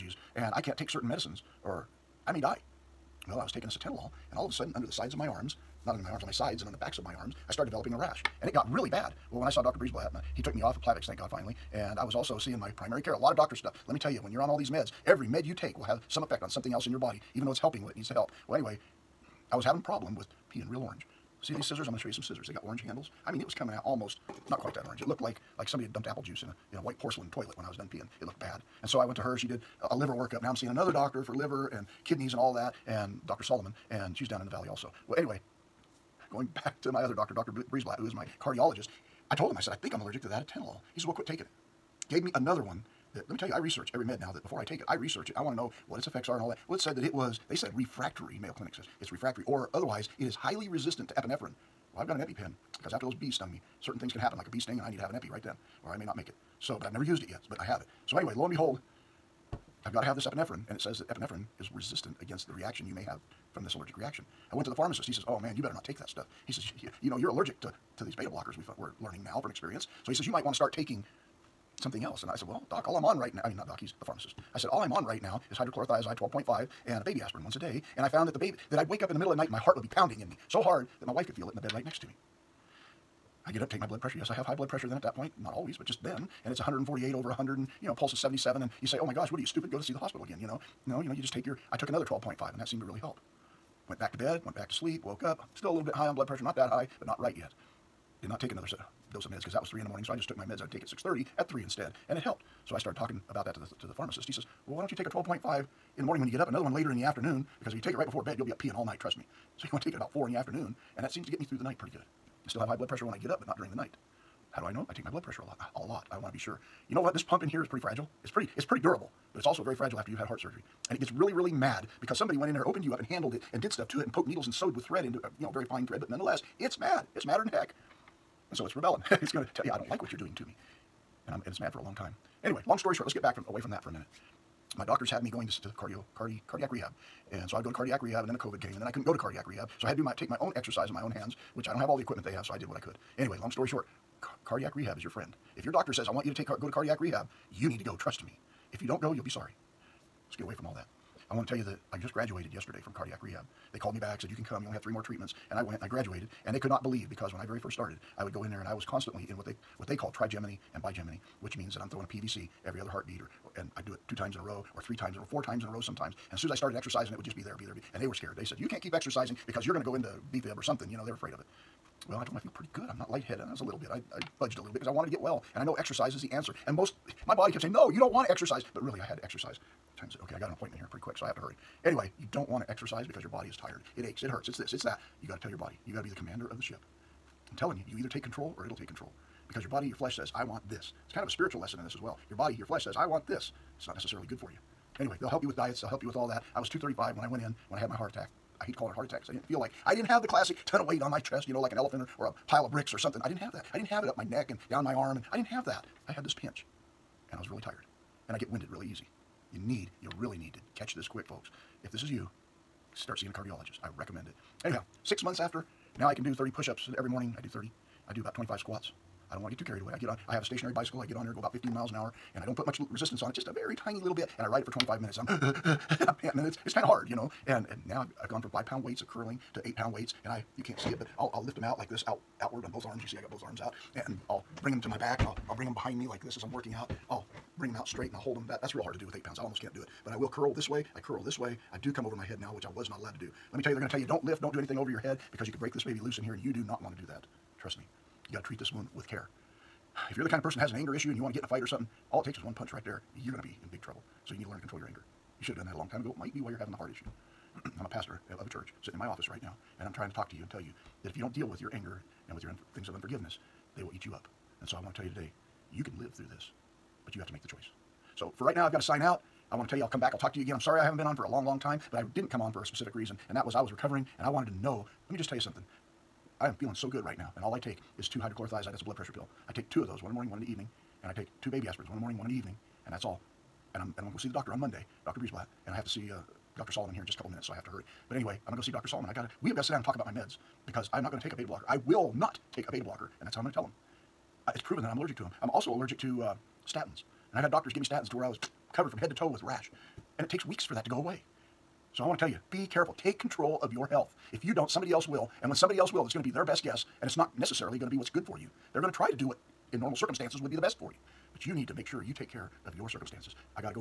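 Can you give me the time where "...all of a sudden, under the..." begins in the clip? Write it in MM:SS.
00:04.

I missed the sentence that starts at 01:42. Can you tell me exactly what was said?
So I started talking about that to the, to the pharmacist.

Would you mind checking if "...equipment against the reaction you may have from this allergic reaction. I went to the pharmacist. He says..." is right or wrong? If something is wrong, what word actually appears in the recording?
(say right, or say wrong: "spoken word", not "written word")
wrong: "resistant", not "equipment".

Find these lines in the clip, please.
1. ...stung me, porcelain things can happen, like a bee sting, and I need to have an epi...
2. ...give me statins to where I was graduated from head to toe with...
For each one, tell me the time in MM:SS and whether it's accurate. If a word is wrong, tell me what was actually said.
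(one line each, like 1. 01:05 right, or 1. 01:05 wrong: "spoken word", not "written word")
1. 00:53 wrong: "certain", not "porcelain"
2. 04:57 wrong: "covered", not "graduated".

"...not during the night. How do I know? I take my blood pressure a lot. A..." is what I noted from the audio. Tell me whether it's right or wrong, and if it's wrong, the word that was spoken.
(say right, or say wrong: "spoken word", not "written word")
right.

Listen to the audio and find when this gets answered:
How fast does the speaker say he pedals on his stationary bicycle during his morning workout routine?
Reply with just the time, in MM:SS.
03:41.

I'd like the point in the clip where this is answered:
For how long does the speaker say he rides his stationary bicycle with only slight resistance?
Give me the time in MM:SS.
03:44.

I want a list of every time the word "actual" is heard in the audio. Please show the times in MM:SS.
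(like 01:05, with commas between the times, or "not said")
not said.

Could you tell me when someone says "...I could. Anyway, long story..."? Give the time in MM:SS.
02:22.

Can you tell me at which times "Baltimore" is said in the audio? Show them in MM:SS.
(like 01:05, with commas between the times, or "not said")
not said.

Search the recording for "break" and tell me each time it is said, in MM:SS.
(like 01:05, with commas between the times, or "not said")
04:05.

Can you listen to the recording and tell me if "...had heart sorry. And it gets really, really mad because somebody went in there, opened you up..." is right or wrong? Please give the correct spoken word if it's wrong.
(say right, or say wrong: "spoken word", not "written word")
wrong: "surgery", not "sorry".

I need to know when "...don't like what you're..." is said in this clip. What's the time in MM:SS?
02:09.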